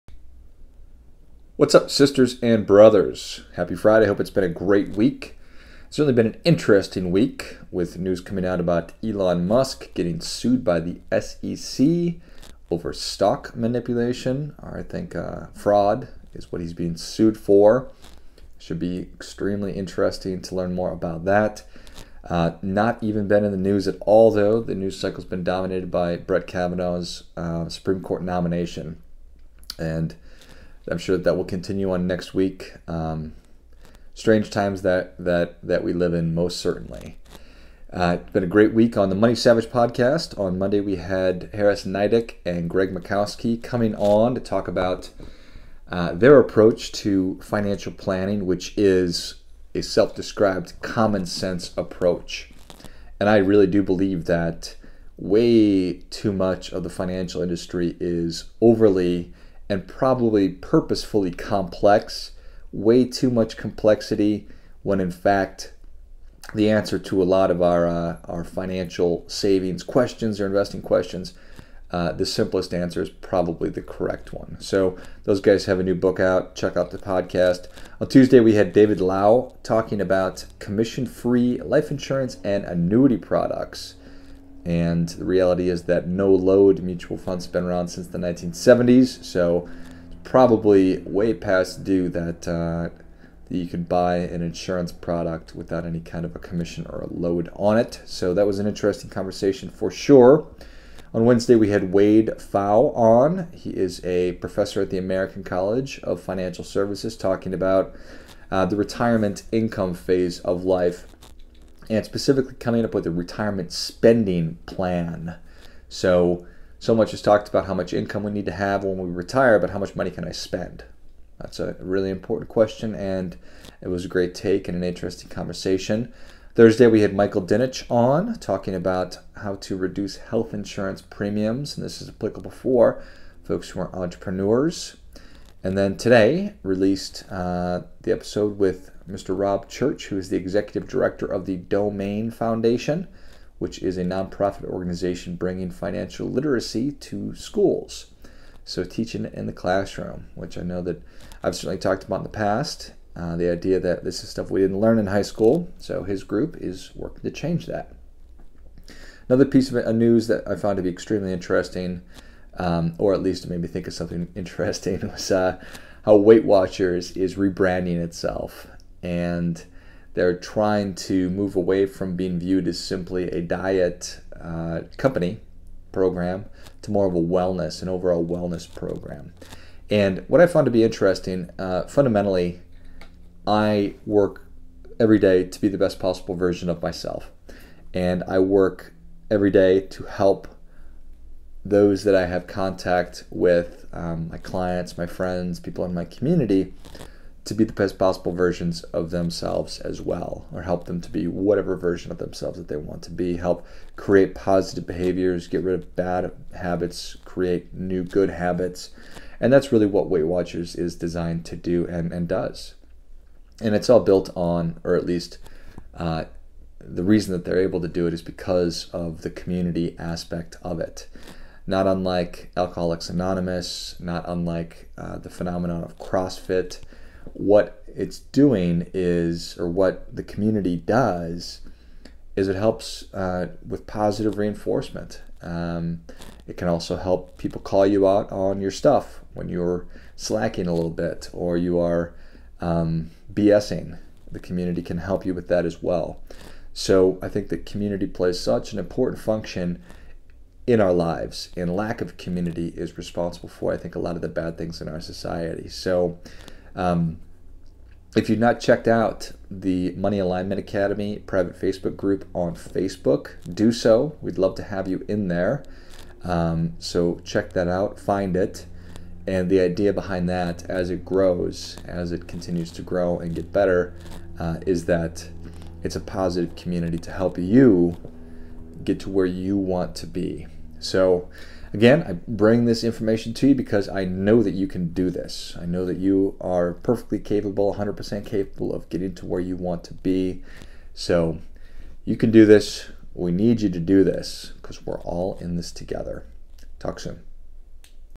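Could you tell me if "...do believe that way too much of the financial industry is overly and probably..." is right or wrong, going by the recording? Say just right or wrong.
right.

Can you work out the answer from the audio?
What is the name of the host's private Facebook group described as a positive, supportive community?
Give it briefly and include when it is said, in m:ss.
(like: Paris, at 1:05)
Money Alignment Academy, at 4:19.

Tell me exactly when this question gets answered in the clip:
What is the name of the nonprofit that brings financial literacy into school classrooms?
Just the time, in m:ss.
2:21.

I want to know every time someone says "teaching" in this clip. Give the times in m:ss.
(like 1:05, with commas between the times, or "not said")
2:28.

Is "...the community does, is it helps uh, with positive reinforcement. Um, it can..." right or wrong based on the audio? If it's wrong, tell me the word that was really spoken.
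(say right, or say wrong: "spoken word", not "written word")
right.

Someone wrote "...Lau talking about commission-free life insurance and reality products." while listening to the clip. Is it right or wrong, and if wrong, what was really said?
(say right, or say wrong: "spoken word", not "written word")
wrong: "annuity", not "reality".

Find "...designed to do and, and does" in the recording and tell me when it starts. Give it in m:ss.
3:30.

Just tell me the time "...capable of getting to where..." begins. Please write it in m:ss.
4:48.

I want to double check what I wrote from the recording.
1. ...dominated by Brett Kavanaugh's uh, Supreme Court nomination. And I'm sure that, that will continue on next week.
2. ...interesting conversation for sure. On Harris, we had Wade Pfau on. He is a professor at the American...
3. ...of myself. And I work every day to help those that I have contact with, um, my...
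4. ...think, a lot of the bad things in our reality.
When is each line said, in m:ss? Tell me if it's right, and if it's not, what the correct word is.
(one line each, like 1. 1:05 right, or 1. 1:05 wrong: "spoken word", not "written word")
1. 0:25 right
2. 1:38 wrong: "Wednesday", not "Harris"
3. 3:06 right
4. 4:13 wrong: "society", not "reality".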